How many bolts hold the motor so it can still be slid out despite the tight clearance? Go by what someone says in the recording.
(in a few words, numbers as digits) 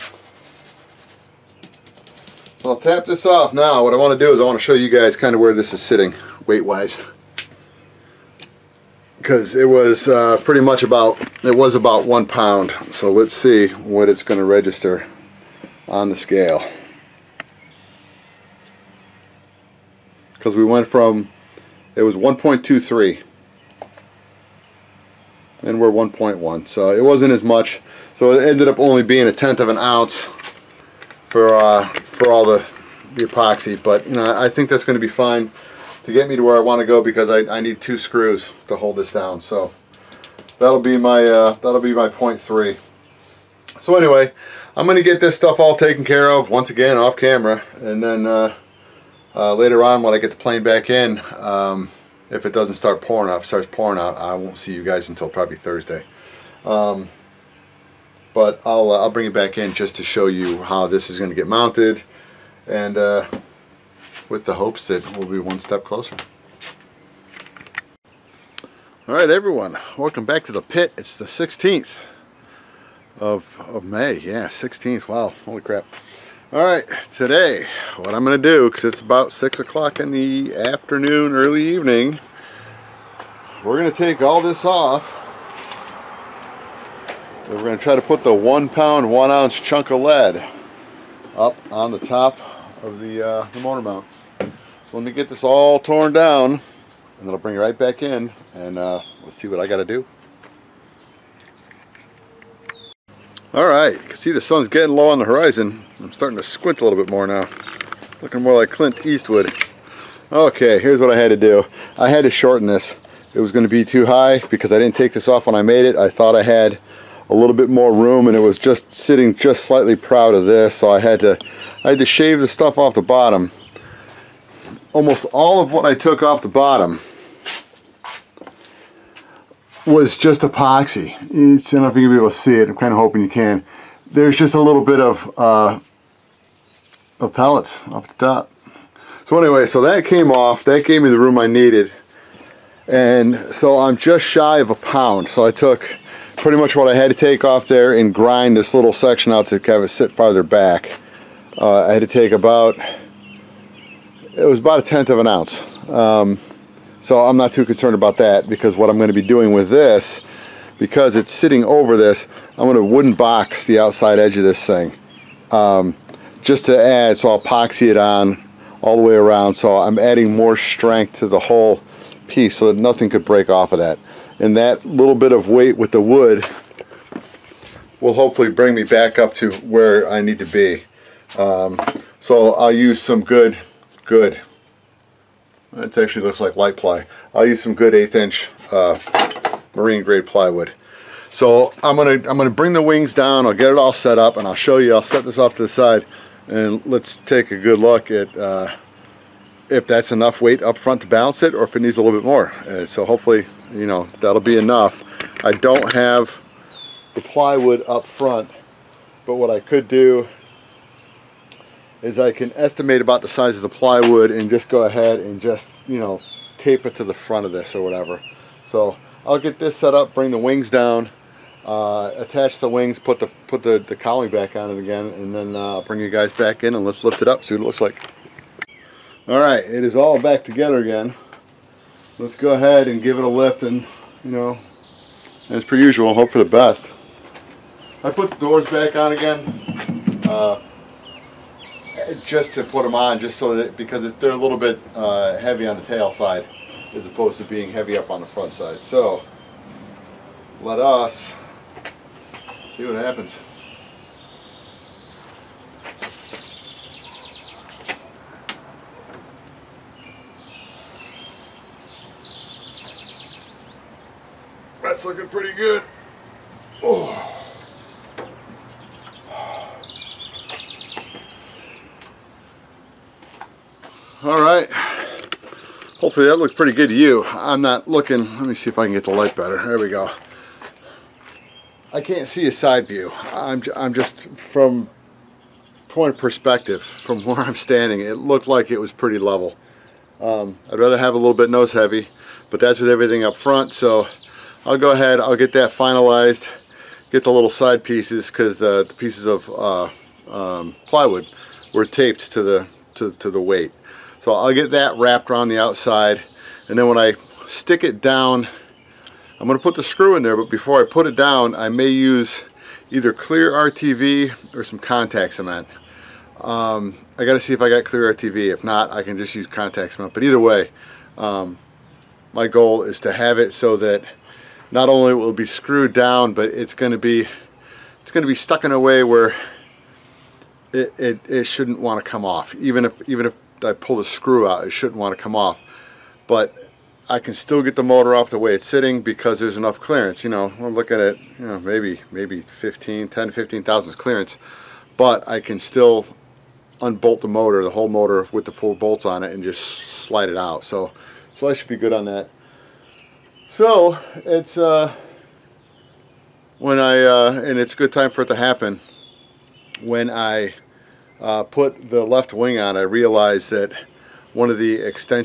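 4.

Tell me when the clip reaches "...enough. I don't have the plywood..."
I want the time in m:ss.
3:24.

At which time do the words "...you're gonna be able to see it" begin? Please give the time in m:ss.
2:11.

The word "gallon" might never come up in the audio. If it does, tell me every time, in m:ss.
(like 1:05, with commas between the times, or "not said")
not said.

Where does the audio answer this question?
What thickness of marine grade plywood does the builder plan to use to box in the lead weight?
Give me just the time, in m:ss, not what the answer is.
3:07.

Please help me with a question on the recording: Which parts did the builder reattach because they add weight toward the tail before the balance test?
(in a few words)
the doors.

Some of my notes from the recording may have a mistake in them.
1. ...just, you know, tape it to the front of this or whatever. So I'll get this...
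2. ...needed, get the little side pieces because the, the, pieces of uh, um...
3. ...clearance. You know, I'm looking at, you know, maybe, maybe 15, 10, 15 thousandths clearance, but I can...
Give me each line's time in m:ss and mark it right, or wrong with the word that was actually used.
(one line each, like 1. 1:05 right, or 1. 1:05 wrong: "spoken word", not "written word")
1. 3:35 right
2. 4:55 wrong: "finalized", not "needed"
3. 5:39 right.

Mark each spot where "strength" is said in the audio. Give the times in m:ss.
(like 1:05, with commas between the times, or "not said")
2:50.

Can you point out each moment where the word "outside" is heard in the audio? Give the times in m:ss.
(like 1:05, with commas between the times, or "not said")
2:43, 5:05.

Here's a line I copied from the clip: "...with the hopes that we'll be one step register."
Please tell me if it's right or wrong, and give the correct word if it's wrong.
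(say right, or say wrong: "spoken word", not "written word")
wrong: "closer", not "register".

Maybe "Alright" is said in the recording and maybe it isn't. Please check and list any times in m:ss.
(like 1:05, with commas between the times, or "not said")
1:09, 3:49.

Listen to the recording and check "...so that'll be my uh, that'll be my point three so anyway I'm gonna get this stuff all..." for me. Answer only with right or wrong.
right.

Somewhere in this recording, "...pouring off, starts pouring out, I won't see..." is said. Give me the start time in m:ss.
0:52.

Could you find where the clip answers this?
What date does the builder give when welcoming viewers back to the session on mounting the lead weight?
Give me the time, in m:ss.
1:11.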